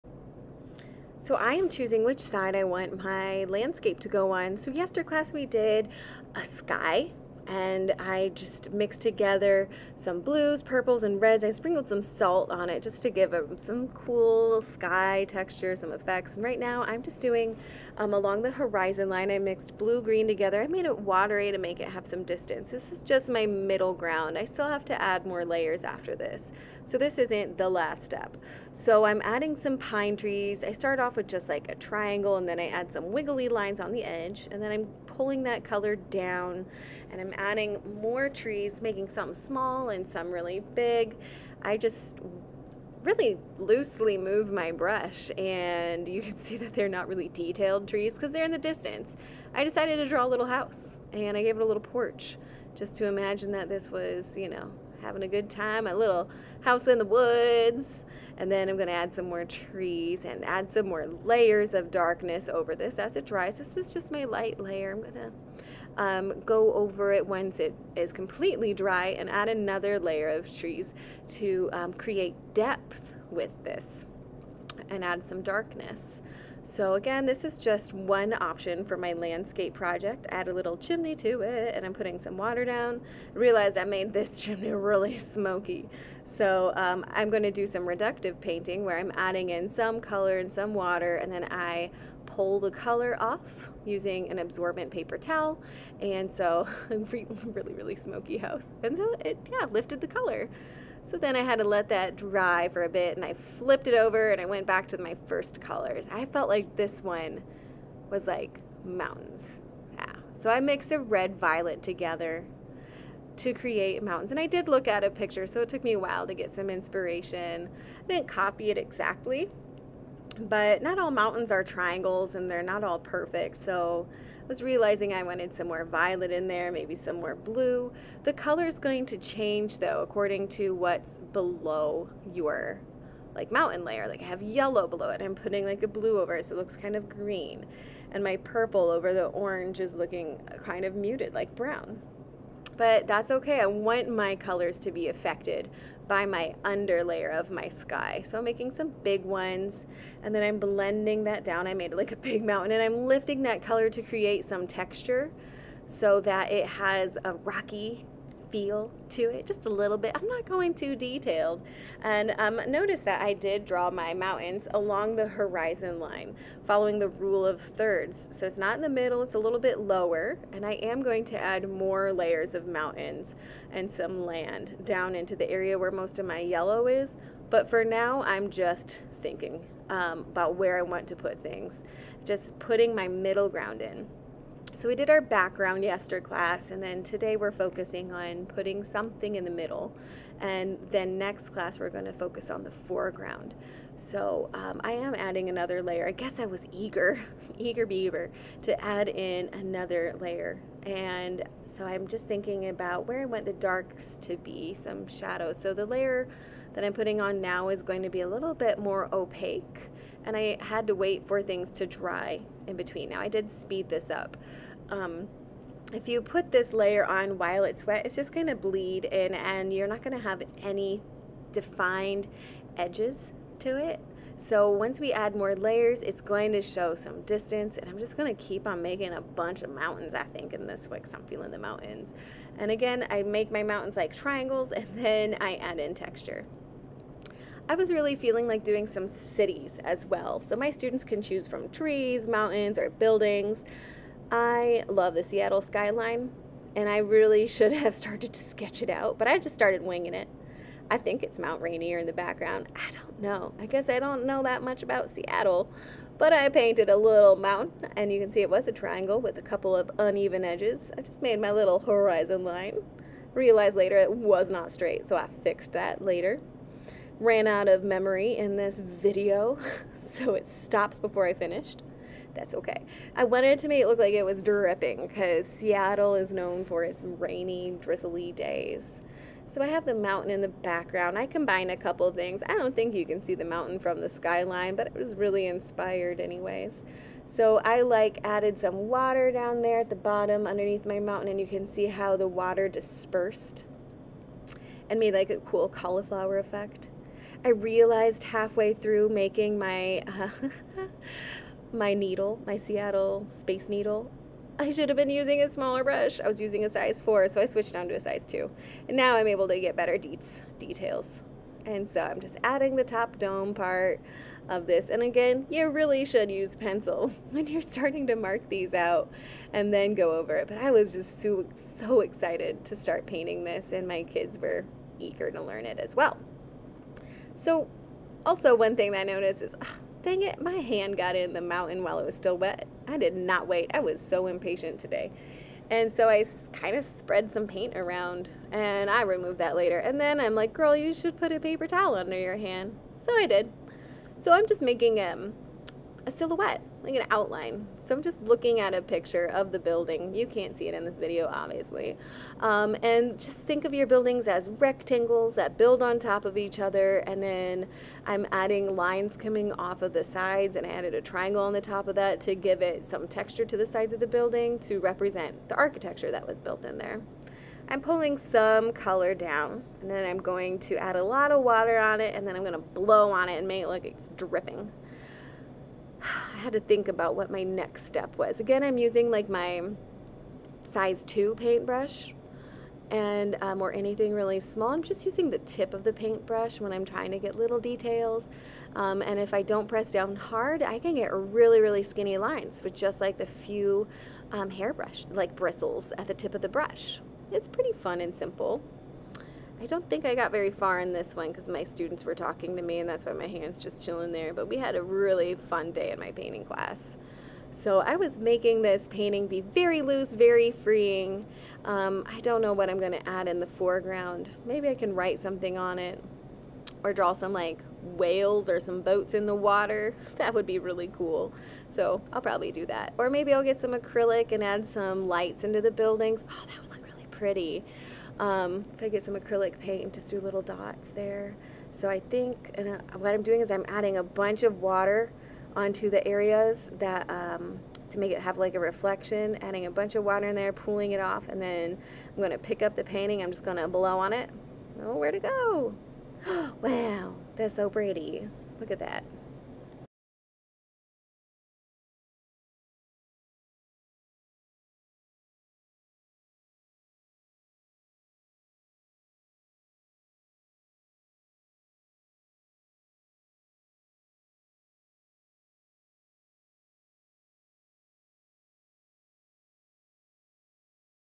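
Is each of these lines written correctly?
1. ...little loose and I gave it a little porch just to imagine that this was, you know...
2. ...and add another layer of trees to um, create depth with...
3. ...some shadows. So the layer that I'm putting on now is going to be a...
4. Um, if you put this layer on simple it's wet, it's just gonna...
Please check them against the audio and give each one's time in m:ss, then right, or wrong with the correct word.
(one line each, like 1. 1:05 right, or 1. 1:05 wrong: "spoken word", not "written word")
1. 0:50 wrong: "house", not "loose"
2. 1:09 right
3. 3:24 right
4. 3:34 wrong: "while", not "simple".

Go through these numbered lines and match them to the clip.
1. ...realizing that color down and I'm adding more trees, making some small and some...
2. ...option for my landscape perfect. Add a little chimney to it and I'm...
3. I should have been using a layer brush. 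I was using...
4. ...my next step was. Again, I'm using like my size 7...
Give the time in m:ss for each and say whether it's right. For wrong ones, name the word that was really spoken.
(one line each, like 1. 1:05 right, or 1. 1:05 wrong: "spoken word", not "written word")
1. 0:35 wrong: "pulling", not "realizing"
2. 1:18 wrong: "project", not "perfect"
3. 5:04 wrong: "smaller", not "layer"
4. 6:17 wrong: "2", not "7".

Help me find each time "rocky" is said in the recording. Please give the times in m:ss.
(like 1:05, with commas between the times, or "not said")
2:37.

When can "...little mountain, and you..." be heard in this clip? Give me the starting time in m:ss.
4:16.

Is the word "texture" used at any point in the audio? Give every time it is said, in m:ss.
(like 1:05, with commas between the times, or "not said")
0:15, 2:34, 3:55, 6:03.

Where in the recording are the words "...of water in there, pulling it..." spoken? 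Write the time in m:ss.
7:19.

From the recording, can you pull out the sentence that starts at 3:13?
So um, I am adding another layer.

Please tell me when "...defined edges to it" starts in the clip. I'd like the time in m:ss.
3:41.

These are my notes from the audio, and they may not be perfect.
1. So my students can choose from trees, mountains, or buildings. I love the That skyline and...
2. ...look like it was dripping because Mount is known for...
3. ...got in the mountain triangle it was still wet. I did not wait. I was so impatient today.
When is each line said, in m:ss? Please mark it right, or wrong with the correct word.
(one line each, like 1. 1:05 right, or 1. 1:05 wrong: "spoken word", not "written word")
1. 4:00 wrong: "Seattle", not "That"
2. 4:33 wrong: "Seattle", not "Mount"
3. 5:30 wrong: "while", not "triangle".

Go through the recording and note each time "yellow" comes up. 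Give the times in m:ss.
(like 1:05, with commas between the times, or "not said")
2:14, 2:56.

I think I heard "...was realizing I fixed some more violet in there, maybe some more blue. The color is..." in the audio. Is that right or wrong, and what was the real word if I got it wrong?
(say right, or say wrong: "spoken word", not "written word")
wrong: "wanted", not "fixed".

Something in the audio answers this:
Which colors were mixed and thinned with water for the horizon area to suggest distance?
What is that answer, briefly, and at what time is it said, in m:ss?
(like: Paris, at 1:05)
Blue-green, at 0:19.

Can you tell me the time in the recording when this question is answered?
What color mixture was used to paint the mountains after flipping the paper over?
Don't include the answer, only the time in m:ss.
1:50.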